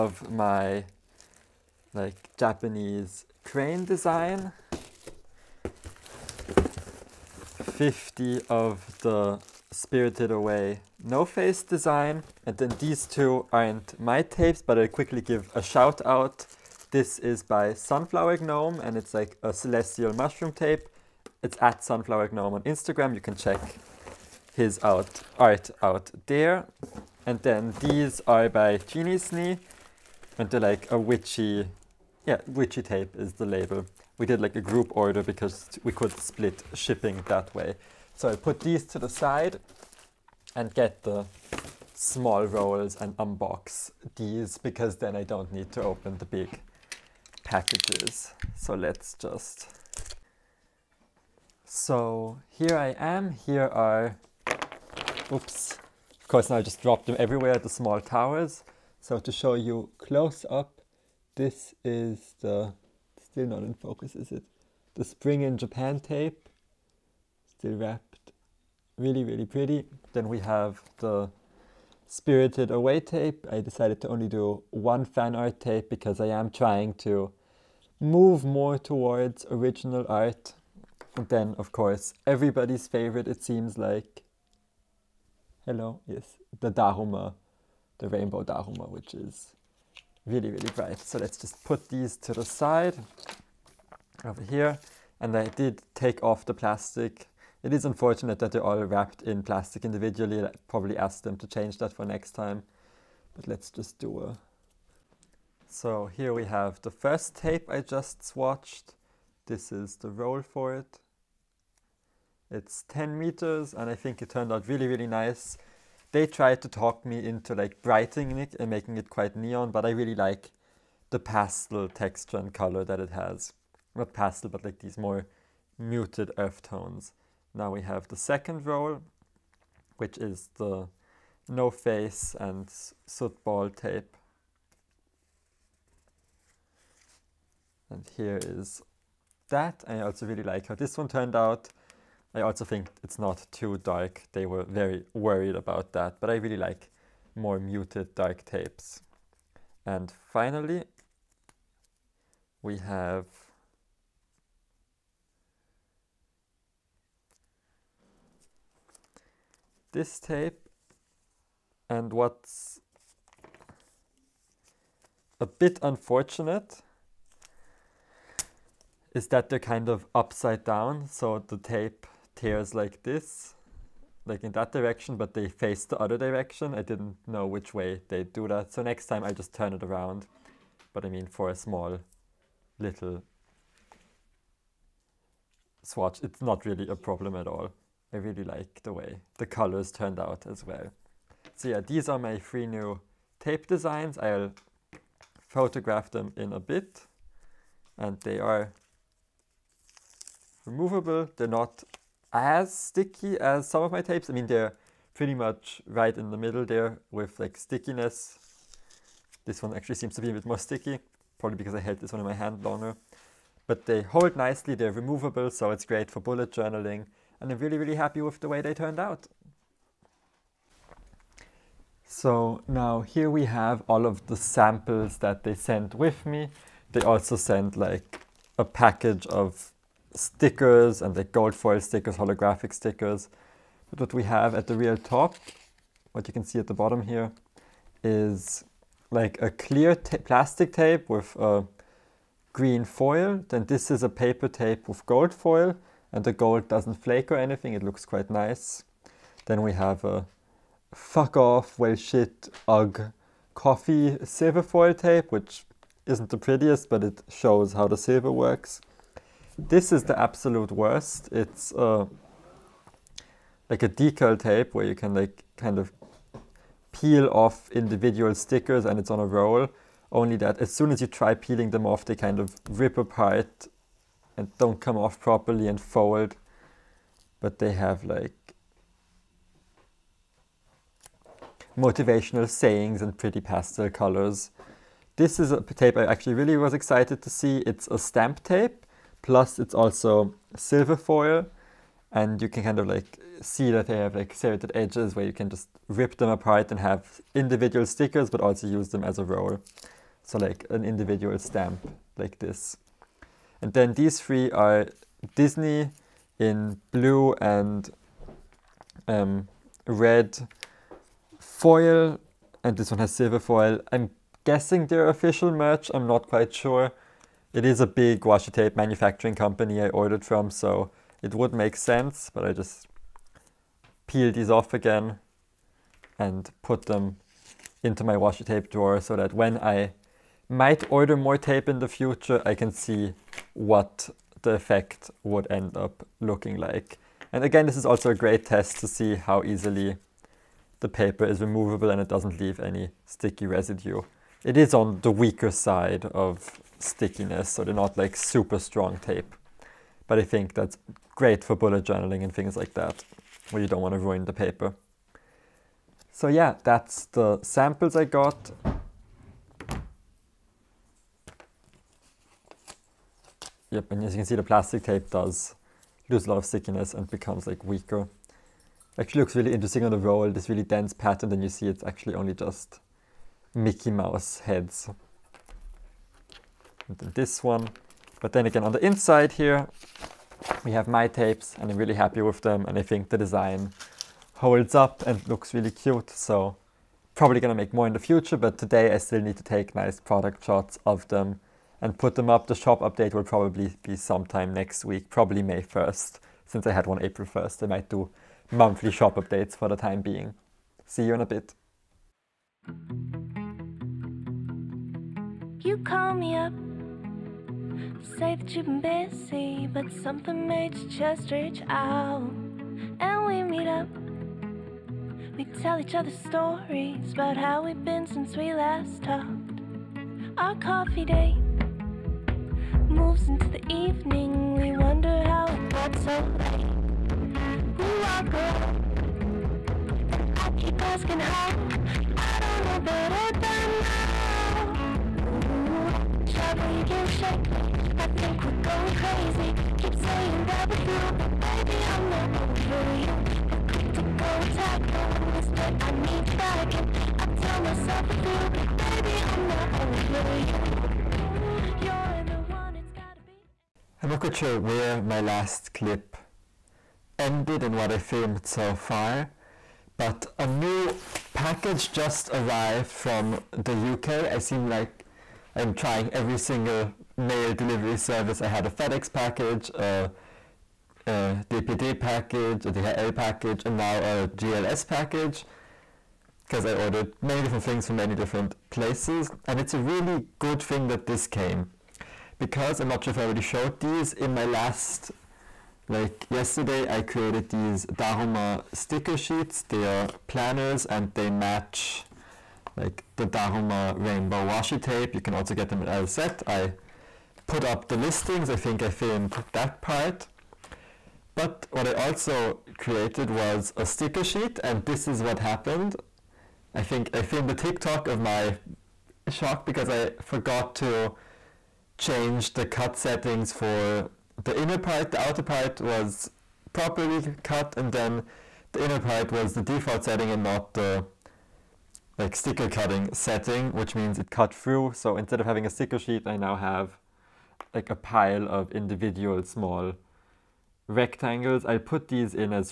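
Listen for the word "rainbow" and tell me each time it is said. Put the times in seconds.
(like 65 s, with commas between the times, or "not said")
88 s, 493 s.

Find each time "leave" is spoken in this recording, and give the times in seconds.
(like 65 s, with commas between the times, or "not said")
342 s.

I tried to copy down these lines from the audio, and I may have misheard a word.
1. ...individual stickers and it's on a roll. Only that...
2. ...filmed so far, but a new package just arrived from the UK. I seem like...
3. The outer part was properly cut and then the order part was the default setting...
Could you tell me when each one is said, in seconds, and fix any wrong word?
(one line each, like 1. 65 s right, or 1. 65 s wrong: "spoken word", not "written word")
1. 267 s right
2. 457 s right
3. 515 s wrong: "inner", not "order".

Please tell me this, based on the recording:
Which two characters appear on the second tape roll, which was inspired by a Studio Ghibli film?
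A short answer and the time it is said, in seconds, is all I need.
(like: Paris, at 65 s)
No Face and soot ball, at 131 s.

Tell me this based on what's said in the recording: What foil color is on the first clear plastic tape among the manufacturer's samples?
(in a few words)
green.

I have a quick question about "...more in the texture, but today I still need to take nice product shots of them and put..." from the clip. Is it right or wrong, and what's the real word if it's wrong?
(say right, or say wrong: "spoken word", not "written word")
wrong: "future", not "texture".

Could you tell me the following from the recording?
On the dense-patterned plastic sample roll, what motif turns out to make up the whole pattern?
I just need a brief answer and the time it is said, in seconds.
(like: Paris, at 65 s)
Mickey Mouse heads, at 373 s.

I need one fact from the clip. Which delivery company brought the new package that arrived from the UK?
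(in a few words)
GLS.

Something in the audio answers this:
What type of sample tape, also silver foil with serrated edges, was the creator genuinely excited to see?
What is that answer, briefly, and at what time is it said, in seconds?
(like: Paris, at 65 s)
stamp tape, at 287 s.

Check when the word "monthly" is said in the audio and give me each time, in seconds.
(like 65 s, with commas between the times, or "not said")
398 s.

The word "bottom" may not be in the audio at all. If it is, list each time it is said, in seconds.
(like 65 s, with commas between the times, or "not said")
236 s.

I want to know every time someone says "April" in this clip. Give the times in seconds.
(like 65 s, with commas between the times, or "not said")
397 s.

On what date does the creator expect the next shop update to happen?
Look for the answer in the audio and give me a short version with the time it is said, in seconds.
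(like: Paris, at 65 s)
May 1st, at 395 s.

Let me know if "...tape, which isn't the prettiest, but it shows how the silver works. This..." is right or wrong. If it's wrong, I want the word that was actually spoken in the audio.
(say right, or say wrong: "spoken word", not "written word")
right.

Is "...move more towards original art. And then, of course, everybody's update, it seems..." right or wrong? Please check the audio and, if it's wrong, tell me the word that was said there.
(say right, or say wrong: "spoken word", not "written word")
wrong: "favorite", not "update".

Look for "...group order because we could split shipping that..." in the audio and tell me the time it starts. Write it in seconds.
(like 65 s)
34 s.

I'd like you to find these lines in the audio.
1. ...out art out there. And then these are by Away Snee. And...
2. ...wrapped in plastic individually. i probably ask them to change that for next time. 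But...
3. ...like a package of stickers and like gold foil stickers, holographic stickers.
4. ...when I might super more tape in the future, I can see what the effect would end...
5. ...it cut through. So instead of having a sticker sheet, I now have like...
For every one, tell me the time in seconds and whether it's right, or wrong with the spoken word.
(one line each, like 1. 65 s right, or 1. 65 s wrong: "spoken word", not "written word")
1. 24 s wrong: "Genie", not "Away"
2. 98 s right
3. 227 s right
4. 329 s wrong: "order", not "super"
5. 524 s right.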